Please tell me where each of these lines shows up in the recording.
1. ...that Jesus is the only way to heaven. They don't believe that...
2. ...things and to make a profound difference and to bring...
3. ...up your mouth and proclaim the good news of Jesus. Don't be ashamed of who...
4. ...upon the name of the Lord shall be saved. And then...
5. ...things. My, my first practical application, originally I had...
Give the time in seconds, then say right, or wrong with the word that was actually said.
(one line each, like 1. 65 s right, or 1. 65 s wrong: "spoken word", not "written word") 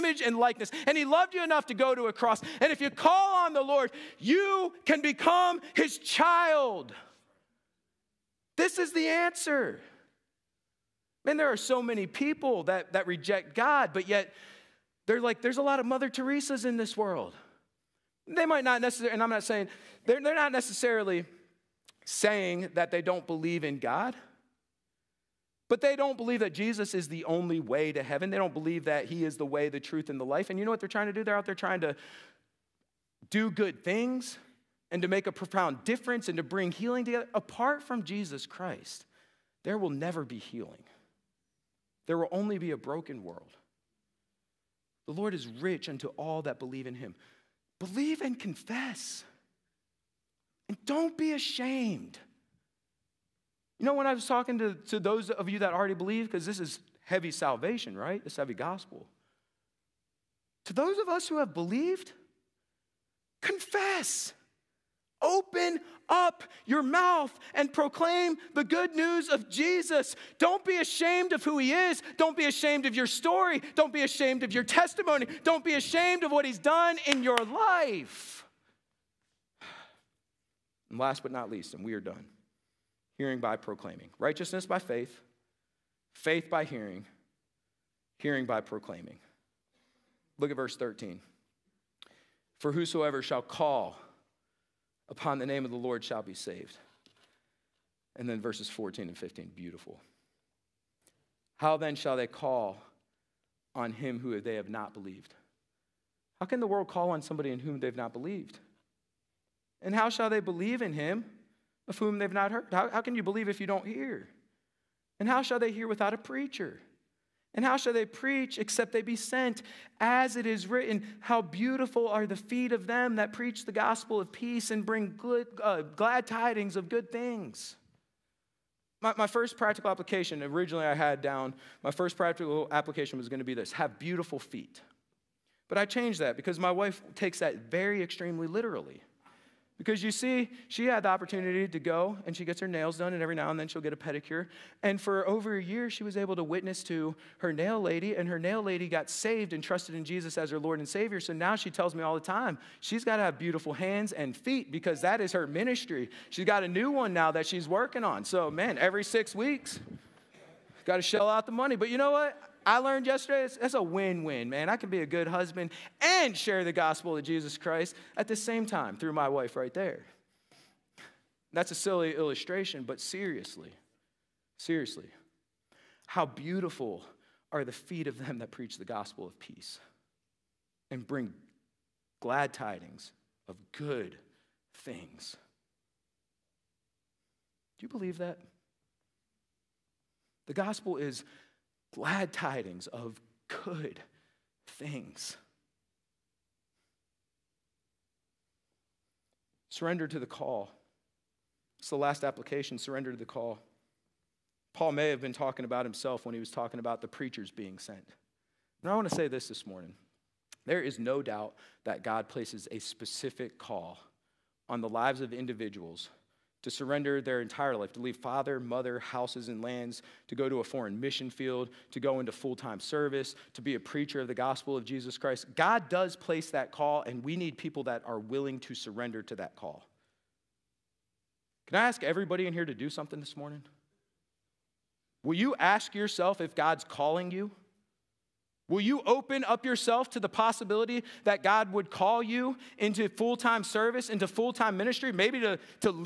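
1. 26 s right
2. 33 s right
3. 66 s right
4. 95 s right
5. 127 s right.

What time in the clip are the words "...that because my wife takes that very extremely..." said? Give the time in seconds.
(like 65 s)
136 s.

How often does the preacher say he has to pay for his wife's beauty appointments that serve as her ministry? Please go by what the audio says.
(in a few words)
Every six weeks.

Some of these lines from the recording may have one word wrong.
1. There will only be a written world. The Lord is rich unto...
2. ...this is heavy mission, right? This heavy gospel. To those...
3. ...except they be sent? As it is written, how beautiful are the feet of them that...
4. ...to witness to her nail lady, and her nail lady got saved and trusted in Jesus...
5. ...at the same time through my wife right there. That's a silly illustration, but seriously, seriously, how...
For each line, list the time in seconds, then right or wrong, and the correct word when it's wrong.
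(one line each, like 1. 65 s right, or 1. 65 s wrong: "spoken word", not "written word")
1. 42 s wrong: "broken", not "written"
2. 56 s wrong: "salvation", not "mission"
3. 118 s right
4. 146 s right
5. 168 s right.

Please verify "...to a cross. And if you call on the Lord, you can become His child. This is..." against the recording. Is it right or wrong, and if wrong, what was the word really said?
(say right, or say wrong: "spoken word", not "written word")
right.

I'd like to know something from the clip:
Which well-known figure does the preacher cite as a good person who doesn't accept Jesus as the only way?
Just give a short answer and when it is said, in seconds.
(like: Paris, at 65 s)
Mother Teresa, at 15 s.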